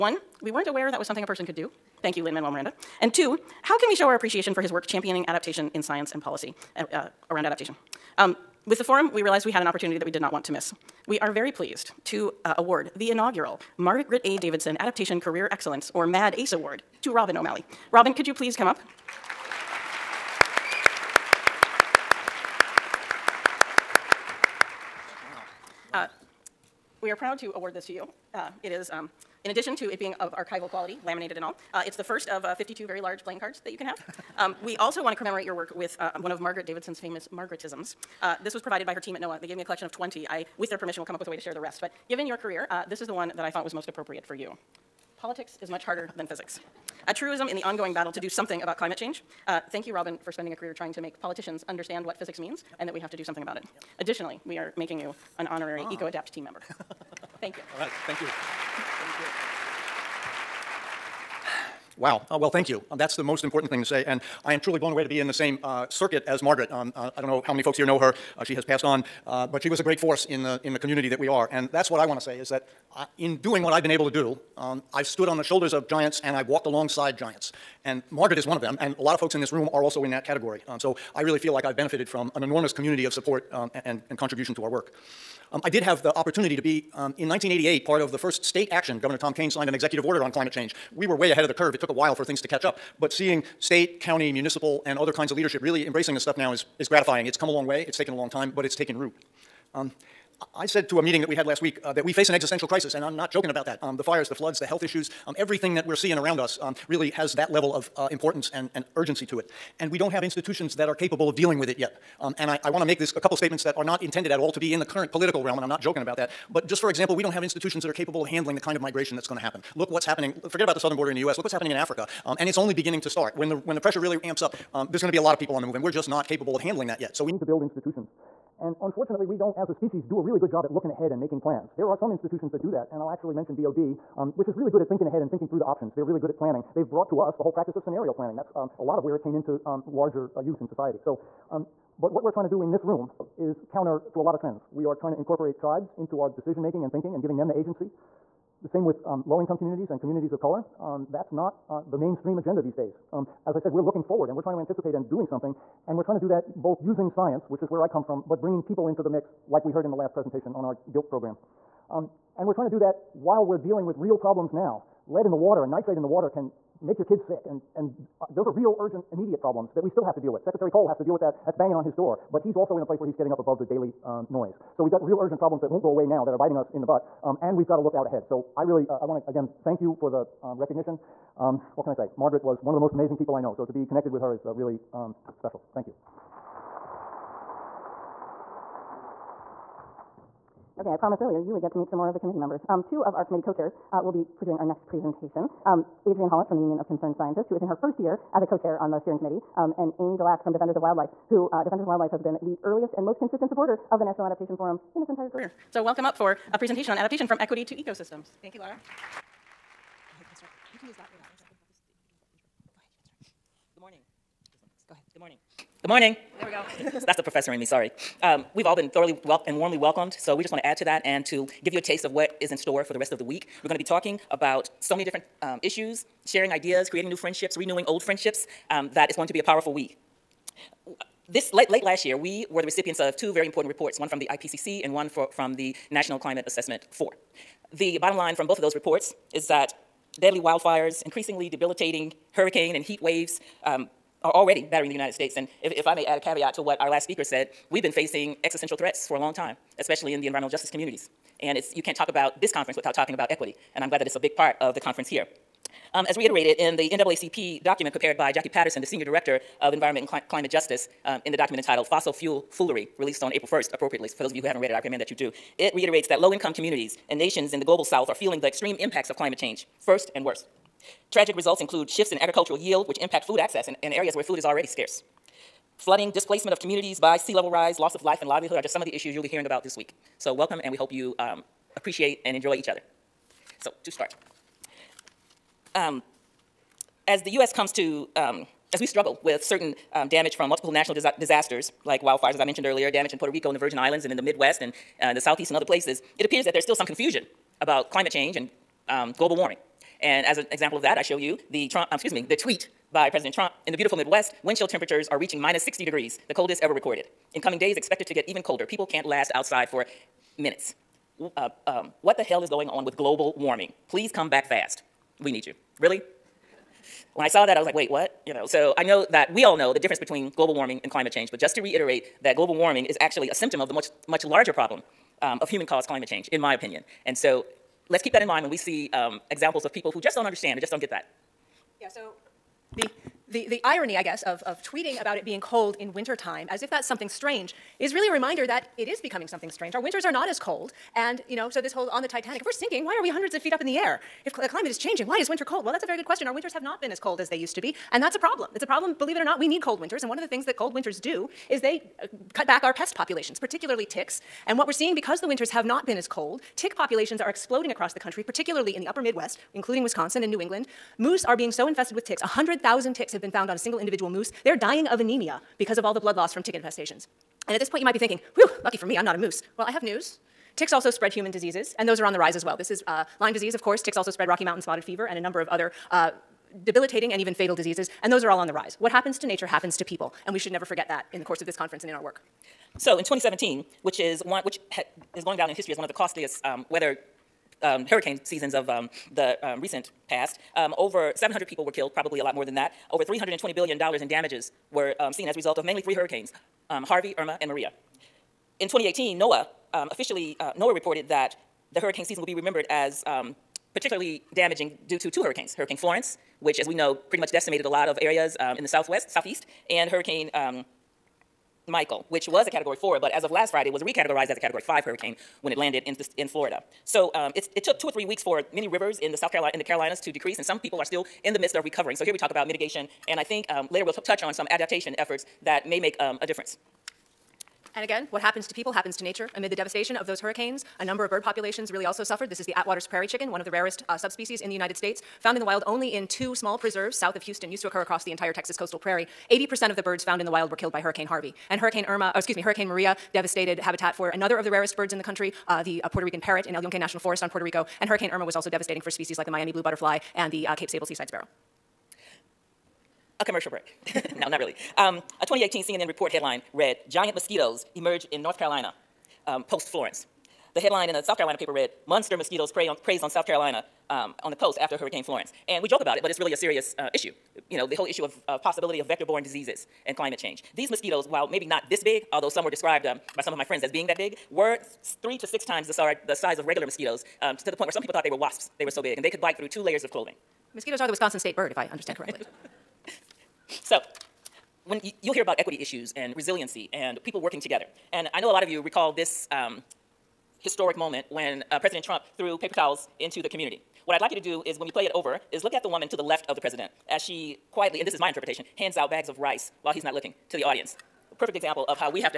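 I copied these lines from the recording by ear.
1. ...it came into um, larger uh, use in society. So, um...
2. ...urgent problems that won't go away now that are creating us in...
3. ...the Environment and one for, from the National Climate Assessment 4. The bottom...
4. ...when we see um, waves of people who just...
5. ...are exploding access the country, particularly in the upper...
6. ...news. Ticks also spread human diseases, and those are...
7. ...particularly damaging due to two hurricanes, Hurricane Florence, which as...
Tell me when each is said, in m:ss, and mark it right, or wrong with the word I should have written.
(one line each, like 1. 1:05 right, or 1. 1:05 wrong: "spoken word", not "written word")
1. 2:19 right
2. 2:55 wrong: "biting", not "creating"
3. 3:54 wrong: "IPCC", not "Environment"
4. 5:28 wrong: "examples", not "waves"
5. 5:57 wrong: "across", not "access"
6. 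6:09 right
7. 6:43 right.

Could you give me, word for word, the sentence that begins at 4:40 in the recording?
So welcome, and we hope you um, appreciate and enjoy each other.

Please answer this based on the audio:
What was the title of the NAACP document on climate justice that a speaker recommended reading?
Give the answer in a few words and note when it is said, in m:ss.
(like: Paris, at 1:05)
Fossil Fuel Foolery, at 4:21.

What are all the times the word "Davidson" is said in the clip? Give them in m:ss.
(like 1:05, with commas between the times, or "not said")
0:14, 0:36.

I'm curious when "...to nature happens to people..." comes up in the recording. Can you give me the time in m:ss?
6:19.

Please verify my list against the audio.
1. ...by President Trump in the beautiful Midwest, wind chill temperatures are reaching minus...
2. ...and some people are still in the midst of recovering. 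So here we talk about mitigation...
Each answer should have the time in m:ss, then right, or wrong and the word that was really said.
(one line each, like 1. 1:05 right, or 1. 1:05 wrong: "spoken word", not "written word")
1. 5:02 right
2. 7:00 right.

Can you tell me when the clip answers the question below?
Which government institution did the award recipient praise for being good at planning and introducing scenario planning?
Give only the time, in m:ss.
2:13.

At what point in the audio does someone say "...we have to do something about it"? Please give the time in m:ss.
0:52.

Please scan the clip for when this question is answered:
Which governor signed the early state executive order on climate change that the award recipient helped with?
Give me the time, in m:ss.
1:28.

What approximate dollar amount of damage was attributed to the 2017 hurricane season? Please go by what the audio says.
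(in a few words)
$320 billion.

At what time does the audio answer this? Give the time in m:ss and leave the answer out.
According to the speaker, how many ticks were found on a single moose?
6:02.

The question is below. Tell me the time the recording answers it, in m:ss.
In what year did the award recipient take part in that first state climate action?
1:27.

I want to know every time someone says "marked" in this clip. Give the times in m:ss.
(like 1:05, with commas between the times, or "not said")
not said.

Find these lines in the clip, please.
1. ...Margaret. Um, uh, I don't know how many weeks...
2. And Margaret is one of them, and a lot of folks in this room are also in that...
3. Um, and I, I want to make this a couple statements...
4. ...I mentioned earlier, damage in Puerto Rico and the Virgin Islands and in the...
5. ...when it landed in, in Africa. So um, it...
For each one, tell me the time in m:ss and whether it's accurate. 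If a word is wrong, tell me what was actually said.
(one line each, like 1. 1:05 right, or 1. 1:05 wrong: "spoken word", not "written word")
1. 1:06 wrong: "folks", not "weeks"
2. 1:17 right
3. 1:52 right
4. 4:52 right
5. 6:55 wrong: "Florida", not "Africa".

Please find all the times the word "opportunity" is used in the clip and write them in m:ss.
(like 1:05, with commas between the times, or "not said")
0:09, 1:26.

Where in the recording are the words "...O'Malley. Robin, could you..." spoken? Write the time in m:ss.
0:17.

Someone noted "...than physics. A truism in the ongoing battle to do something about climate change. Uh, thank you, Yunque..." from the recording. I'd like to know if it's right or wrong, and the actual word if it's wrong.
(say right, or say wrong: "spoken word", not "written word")
wrong: "Robin", not "Yunque".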